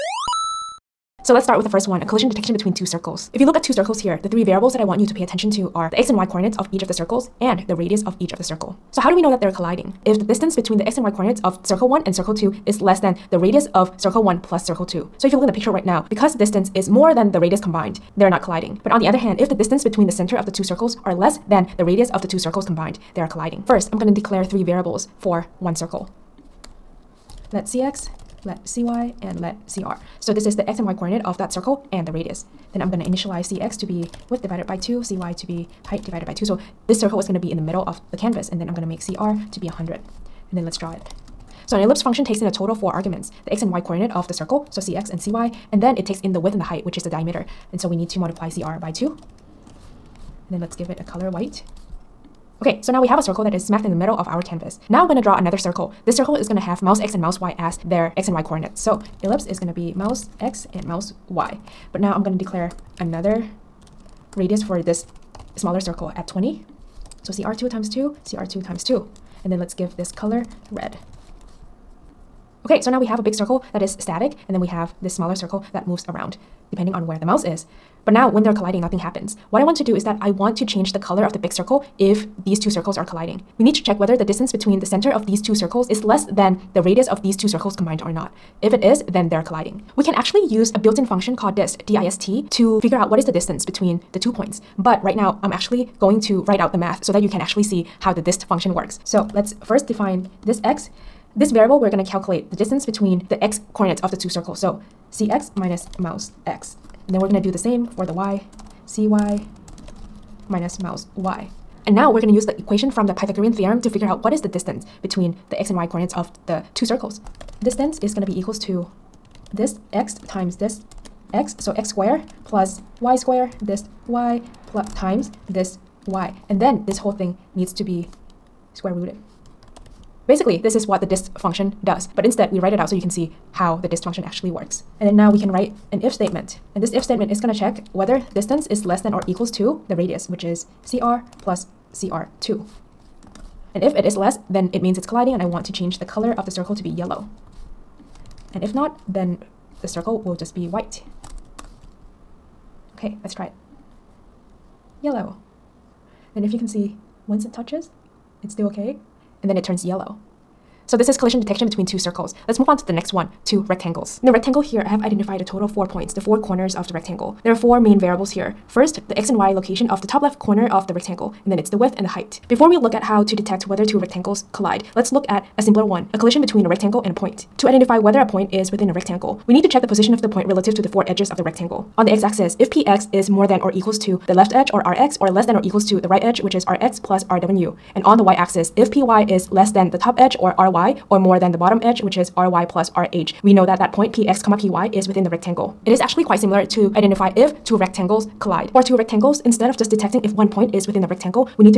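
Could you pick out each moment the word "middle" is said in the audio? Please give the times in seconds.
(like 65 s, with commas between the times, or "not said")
37 s, 53 s.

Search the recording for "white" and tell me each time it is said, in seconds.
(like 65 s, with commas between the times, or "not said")
51 s, 150 s.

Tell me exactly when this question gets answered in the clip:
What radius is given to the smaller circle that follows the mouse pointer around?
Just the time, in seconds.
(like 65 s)
66 s.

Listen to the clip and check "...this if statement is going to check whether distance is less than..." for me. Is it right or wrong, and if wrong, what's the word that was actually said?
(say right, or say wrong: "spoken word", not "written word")
right.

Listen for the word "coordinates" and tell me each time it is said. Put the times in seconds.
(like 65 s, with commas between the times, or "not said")
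6 s, 11 s, 30 s, 43 s, 58 s, 103 s, 115 s.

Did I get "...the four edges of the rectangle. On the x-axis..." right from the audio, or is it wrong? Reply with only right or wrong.
right.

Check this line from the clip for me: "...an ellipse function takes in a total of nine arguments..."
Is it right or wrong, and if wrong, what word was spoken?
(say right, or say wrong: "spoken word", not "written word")
wrong: "four", not "nine".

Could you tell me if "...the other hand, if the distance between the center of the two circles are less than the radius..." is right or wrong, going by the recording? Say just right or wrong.
right.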